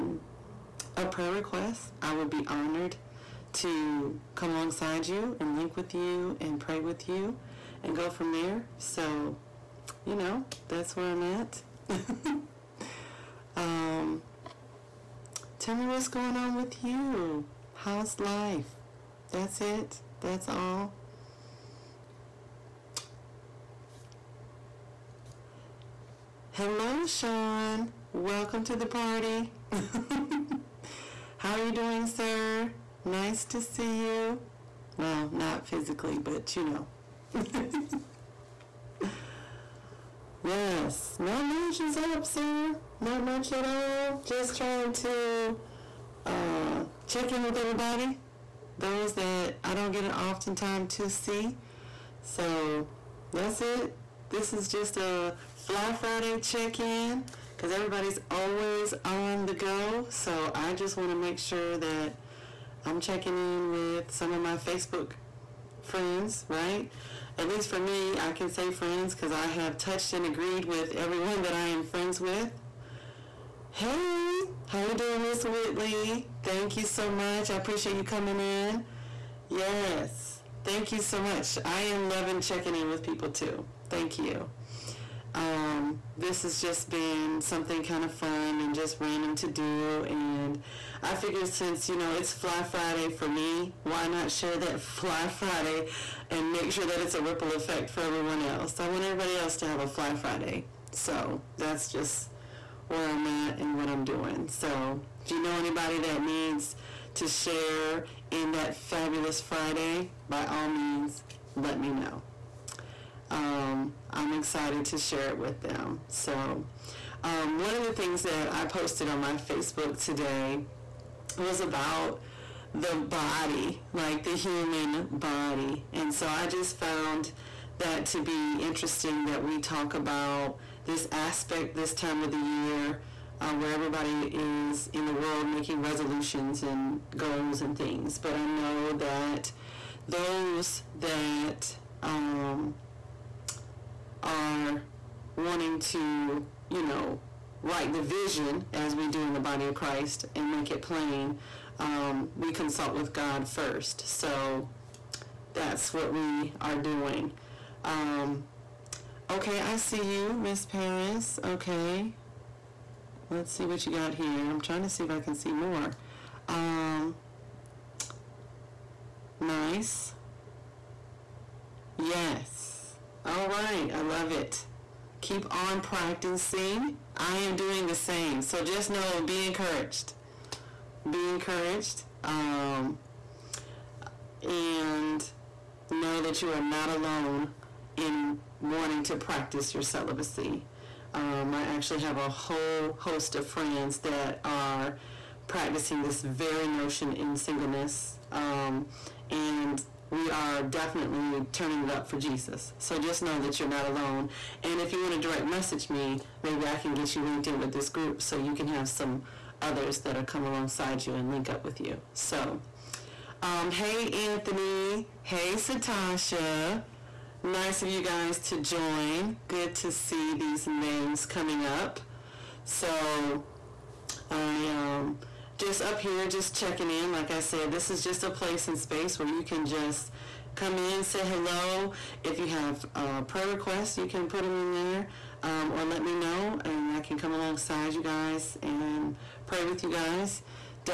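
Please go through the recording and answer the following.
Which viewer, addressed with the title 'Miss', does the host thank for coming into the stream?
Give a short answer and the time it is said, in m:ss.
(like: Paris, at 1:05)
Whitley, at 1:15.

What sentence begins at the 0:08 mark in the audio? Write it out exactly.
So, you know, that's where I'm at.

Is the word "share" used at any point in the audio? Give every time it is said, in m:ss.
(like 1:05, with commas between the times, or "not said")
1:34, 1:47, 1:54.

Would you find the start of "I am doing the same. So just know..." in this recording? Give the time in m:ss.
2:57.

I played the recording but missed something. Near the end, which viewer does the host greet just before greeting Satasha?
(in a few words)
Anthony.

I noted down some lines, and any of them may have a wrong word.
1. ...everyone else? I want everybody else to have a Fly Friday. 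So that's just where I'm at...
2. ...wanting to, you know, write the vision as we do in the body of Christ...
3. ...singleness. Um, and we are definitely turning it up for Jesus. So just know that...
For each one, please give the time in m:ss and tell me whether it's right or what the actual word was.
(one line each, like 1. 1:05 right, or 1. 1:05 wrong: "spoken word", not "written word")
1. 1:38 right
2. 2:25 right
3. 3:17 right.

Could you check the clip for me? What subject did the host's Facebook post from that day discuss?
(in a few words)
The human body.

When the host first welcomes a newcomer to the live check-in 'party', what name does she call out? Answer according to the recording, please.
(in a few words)
Sean.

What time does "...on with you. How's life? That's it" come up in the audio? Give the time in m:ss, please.
0:16.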